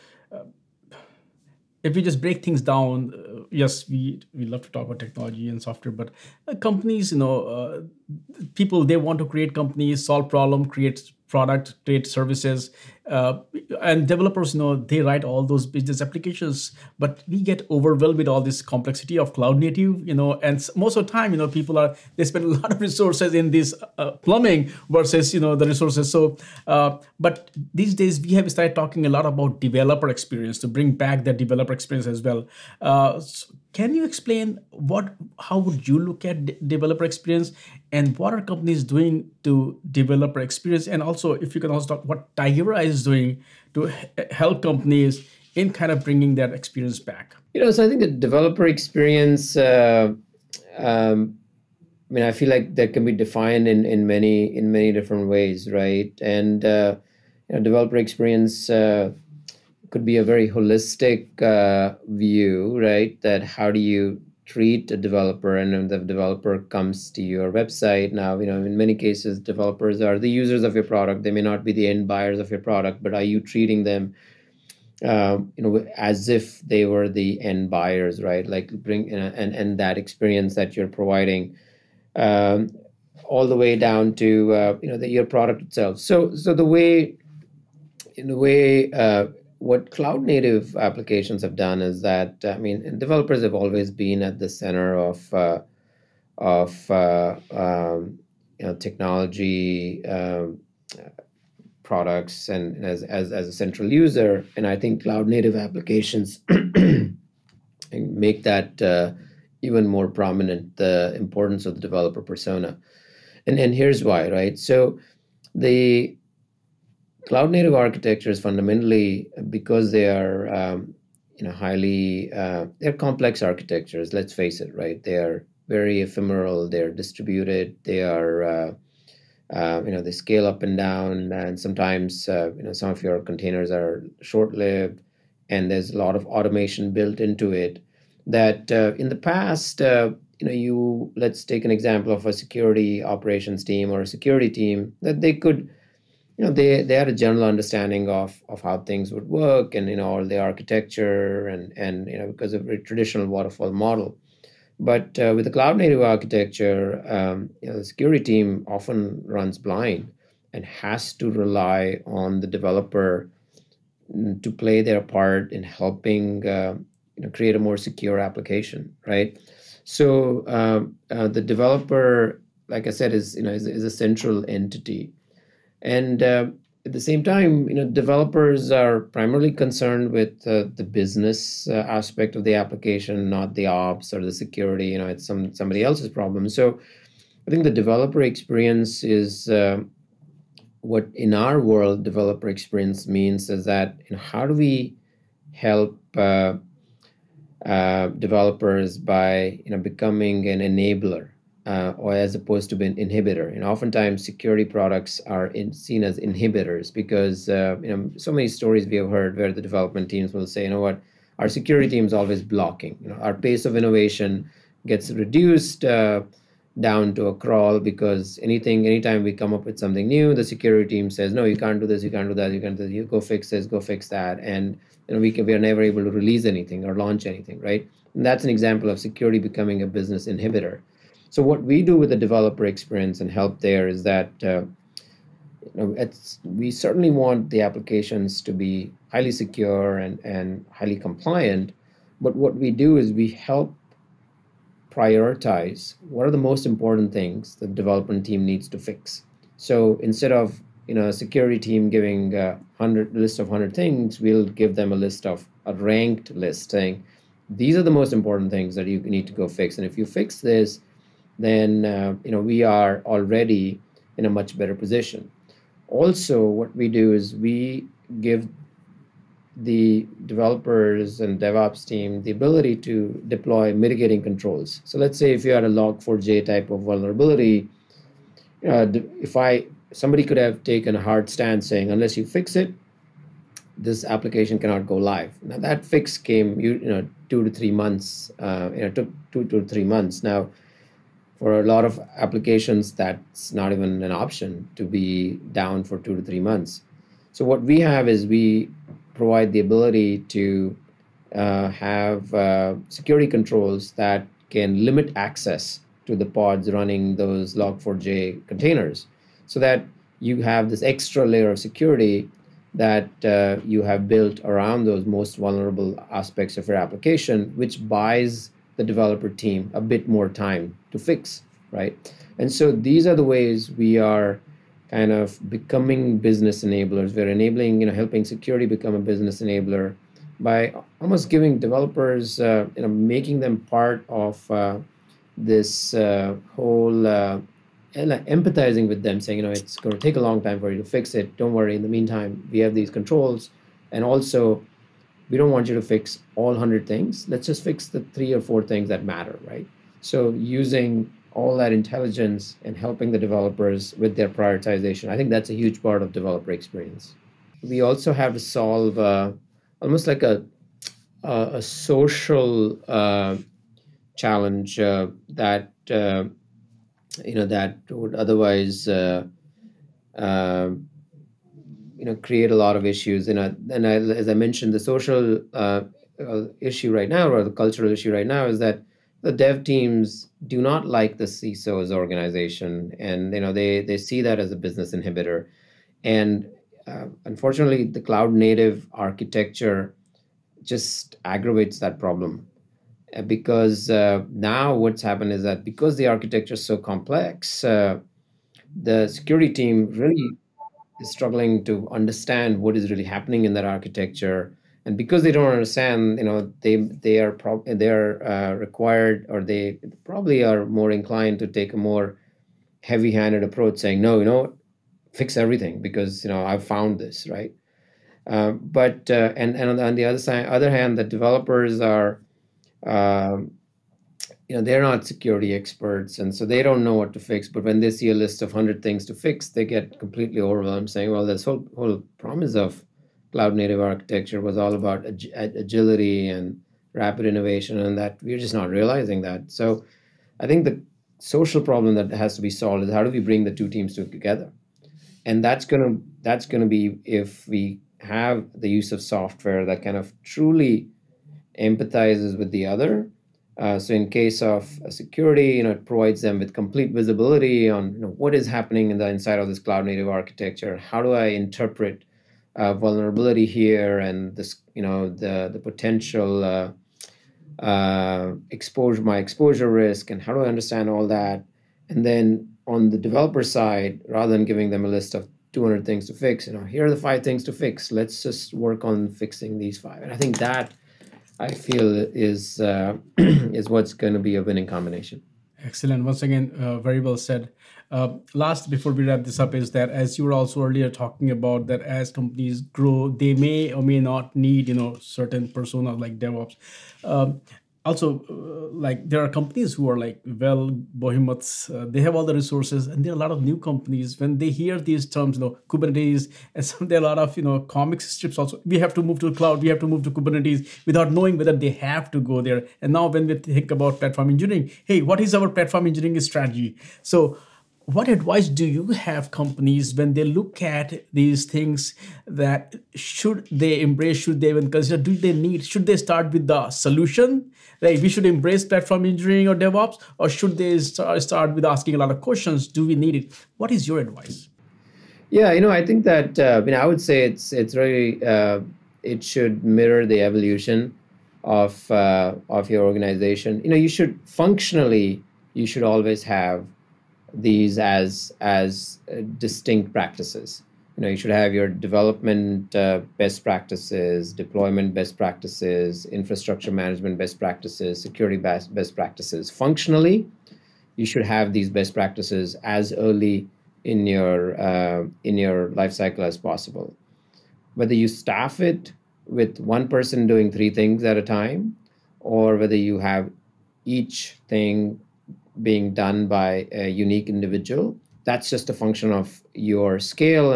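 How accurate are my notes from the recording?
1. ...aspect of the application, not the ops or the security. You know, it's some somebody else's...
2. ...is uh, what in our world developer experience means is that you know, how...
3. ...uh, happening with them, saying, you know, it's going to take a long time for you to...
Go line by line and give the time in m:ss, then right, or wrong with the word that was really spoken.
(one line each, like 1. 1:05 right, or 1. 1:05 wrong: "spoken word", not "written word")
1. 3:01 right
2. 3:09 right
3. 5:37 wrong: "empathizing", not "happening".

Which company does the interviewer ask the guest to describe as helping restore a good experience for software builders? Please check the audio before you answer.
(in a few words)
Tigera.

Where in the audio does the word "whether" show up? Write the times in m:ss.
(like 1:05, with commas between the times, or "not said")
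8:31, 9:27, 9:32.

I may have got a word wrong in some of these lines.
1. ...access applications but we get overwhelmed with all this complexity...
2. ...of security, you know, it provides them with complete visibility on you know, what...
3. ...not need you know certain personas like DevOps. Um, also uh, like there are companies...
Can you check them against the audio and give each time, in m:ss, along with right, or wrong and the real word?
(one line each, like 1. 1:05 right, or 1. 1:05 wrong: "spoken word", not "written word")
1. 0:15 wrong: "business", not "access"
2. 7:34 right
3. 8:13 right.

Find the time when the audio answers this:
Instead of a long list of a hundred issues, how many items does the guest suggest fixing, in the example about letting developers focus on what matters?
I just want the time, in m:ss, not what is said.
5:48.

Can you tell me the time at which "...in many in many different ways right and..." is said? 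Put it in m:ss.
0:53.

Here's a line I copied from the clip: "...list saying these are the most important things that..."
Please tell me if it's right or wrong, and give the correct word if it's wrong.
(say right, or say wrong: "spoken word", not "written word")
right.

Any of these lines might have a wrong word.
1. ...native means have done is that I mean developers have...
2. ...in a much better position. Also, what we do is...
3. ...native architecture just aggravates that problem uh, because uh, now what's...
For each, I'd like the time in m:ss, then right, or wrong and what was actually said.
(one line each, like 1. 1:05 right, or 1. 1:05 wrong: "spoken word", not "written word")
1. 1:30 wrong: "applications", not "means"
2. 4:24 right
3. 6:28 right.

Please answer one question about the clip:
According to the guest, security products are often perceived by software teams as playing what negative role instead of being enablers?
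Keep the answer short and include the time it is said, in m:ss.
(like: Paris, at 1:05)
inhibitors, at 3:26.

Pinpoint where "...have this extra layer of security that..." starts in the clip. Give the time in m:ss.
5:10.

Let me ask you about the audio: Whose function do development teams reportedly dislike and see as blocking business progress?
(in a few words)
the CISO.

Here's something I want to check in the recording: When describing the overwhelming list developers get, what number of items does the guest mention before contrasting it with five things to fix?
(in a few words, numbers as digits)
200.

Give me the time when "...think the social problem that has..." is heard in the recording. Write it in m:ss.
7:20.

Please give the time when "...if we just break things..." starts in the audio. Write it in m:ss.
0:01.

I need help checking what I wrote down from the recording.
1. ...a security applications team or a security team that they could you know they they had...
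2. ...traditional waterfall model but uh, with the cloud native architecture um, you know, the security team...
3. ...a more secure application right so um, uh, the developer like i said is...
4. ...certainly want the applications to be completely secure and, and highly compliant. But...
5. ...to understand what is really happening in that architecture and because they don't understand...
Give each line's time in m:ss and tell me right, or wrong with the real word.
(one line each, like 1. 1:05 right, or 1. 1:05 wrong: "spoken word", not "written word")
1. 2:22 wrong: "operations", not "applications"
2. 2:32 right
3. 2:47 right
4. 3:56 wrong: "highly", not "completely"
5. 6:41 right.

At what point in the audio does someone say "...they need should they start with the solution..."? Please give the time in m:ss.
8:45.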